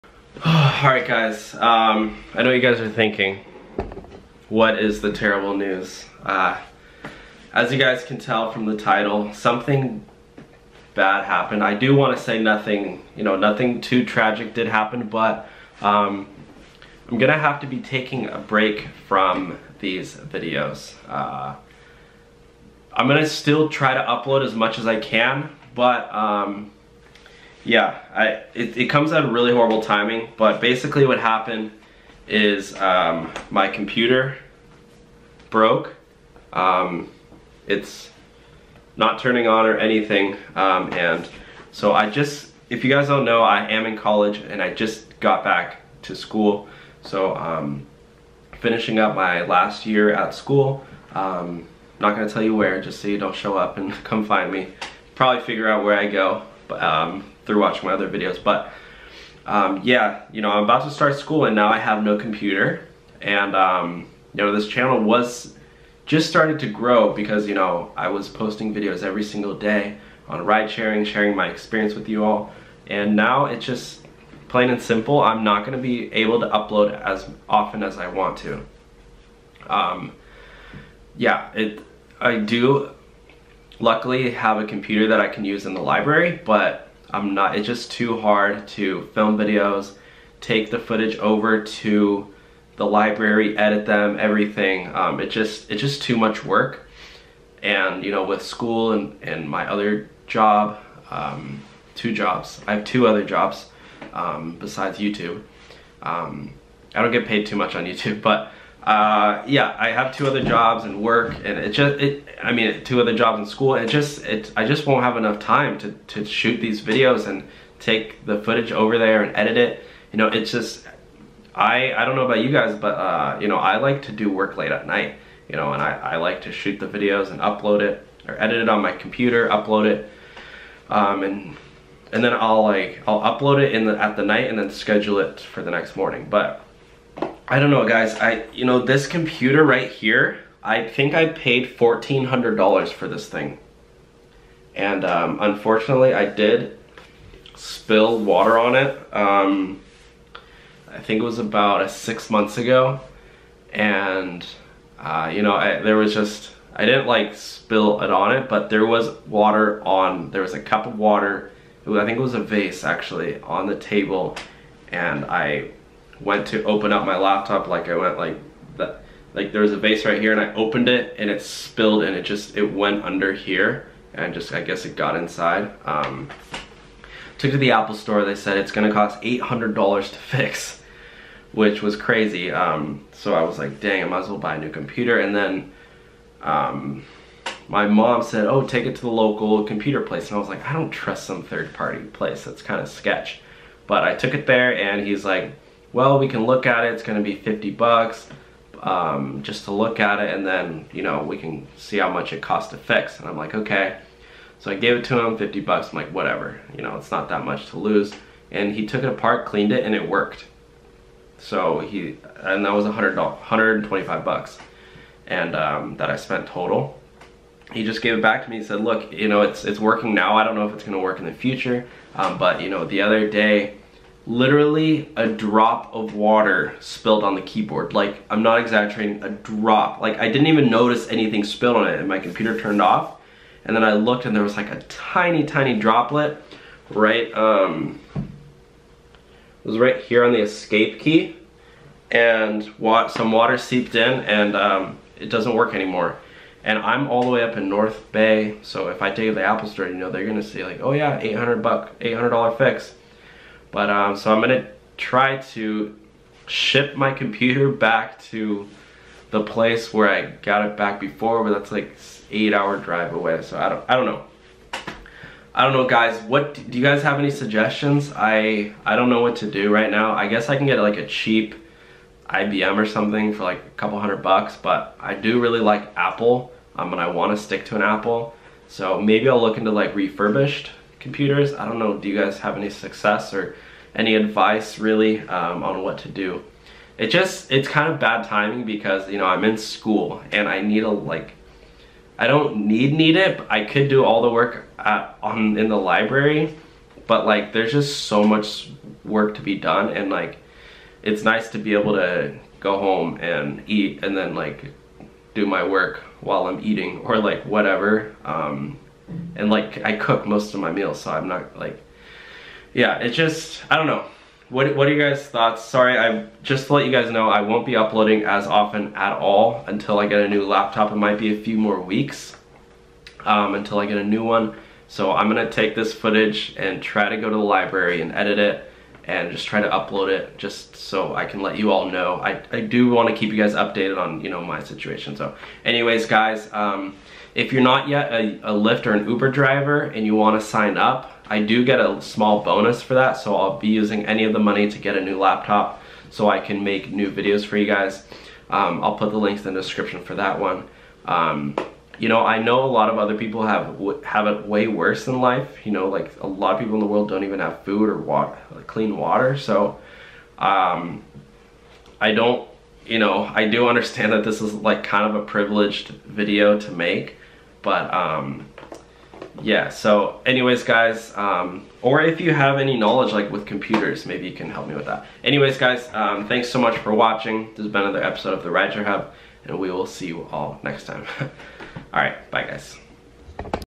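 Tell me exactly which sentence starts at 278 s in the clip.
So maybe I'll look into like refurbished computers.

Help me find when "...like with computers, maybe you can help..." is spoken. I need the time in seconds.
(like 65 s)
373 s.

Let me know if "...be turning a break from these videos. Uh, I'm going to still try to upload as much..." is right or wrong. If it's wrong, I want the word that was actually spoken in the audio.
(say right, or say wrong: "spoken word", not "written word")
wrong: "taking", not "turning".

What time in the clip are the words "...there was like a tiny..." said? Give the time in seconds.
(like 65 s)
234 s.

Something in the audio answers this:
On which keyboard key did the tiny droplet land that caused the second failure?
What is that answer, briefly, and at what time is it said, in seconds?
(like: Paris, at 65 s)
escape key, at 240 s.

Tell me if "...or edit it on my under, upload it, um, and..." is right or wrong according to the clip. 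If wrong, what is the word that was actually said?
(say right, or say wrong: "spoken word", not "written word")
wrong: "computer", not "under".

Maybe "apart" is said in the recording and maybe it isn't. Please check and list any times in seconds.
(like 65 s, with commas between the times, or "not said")
209 s.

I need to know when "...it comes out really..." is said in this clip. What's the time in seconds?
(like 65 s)
28 s.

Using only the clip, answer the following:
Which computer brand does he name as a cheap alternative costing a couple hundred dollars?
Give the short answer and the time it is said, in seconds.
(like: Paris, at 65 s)
IBM, at 272 s.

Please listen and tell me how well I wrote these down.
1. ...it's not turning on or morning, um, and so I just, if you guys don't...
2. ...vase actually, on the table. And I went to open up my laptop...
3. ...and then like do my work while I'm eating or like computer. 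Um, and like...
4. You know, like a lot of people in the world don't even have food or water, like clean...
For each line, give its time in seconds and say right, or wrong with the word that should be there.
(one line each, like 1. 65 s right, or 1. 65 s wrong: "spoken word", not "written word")
1. 37 s wrong: "anything", not "morning"
2. 162 s right
3. 304 s wrong: "whatever", not "computer"
4. 355 s right.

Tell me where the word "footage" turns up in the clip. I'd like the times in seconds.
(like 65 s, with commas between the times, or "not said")
90 s, 118 s, 325 s.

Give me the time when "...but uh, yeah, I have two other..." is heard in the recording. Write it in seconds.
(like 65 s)
108 s.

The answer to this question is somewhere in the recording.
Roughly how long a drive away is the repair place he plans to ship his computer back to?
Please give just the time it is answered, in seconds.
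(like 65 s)
262 s.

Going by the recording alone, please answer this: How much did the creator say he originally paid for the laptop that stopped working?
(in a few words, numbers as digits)
$1,400.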